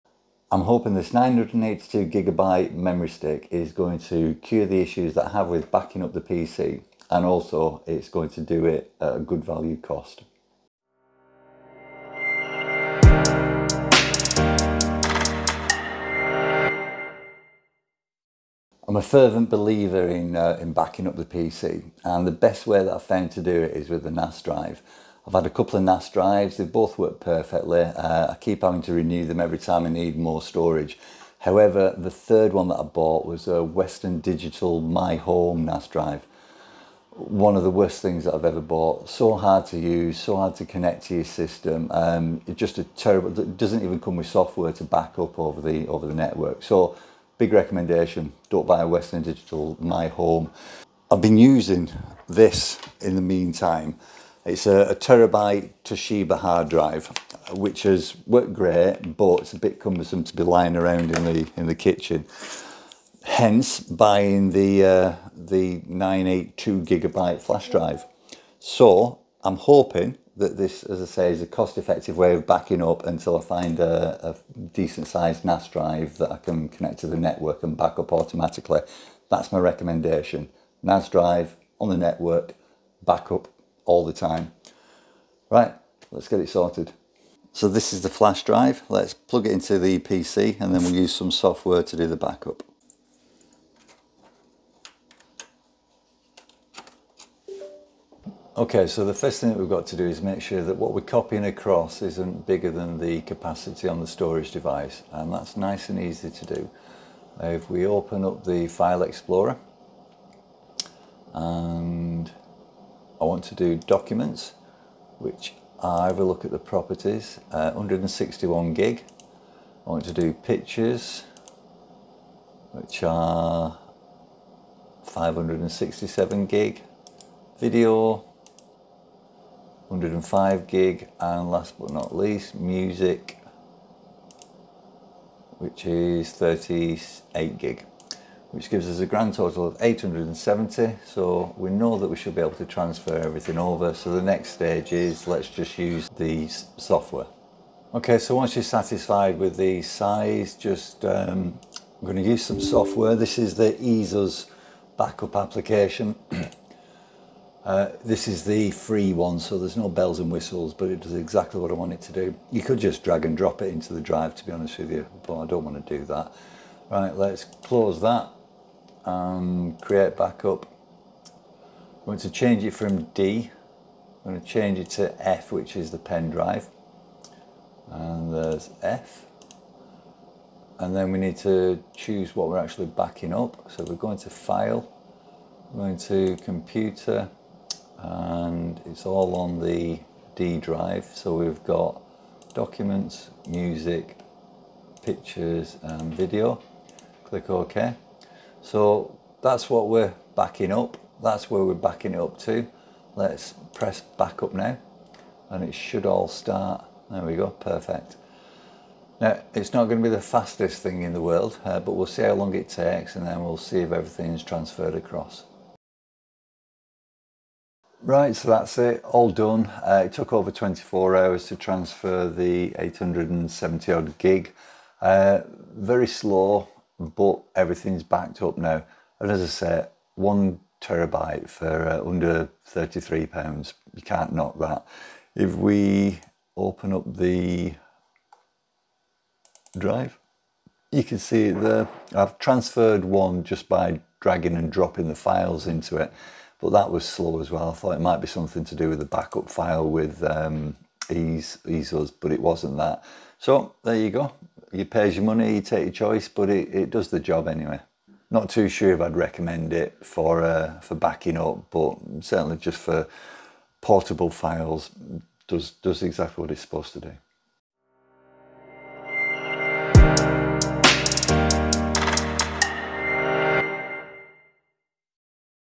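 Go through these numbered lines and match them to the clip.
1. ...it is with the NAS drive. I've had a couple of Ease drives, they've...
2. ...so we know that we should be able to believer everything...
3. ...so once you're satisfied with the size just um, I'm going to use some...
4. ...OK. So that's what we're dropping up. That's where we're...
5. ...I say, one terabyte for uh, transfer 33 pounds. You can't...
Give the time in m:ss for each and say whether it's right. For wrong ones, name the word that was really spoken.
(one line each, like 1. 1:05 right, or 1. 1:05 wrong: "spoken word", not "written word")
1. 0:23 wrong: "NAS", not "Ease"
2. 2:21 wrong: "transfer", not "believer"
3. 2:28 right
4. 3:17 wrong: "backing", not "dropping"
5. 3:49 wrong: "under", not "transfer".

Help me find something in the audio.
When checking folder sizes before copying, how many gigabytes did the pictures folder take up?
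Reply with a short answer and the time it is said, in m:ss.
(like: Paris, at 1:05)
567, at 2:05.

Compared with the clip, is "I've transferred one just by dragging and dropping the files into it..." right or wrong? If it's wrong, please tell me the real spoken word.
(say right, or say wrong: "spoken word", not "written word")
right.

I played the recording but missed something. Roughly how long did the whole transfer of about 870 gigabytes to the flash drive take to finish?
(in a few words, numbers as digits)
over 24 hours.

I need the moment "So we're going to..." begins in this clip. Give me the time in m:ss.
3:03.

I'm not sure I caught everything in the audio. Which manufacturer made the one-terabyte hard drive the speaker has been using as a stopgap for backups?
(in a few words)
Toshiba.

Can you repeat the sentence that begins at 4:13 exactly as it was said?
So there you go you pays your money, you take your choice, but it, it does the job anyway.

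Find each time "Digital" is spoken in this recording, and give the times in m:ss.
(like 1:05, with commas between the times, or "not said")
0:34, 0:49.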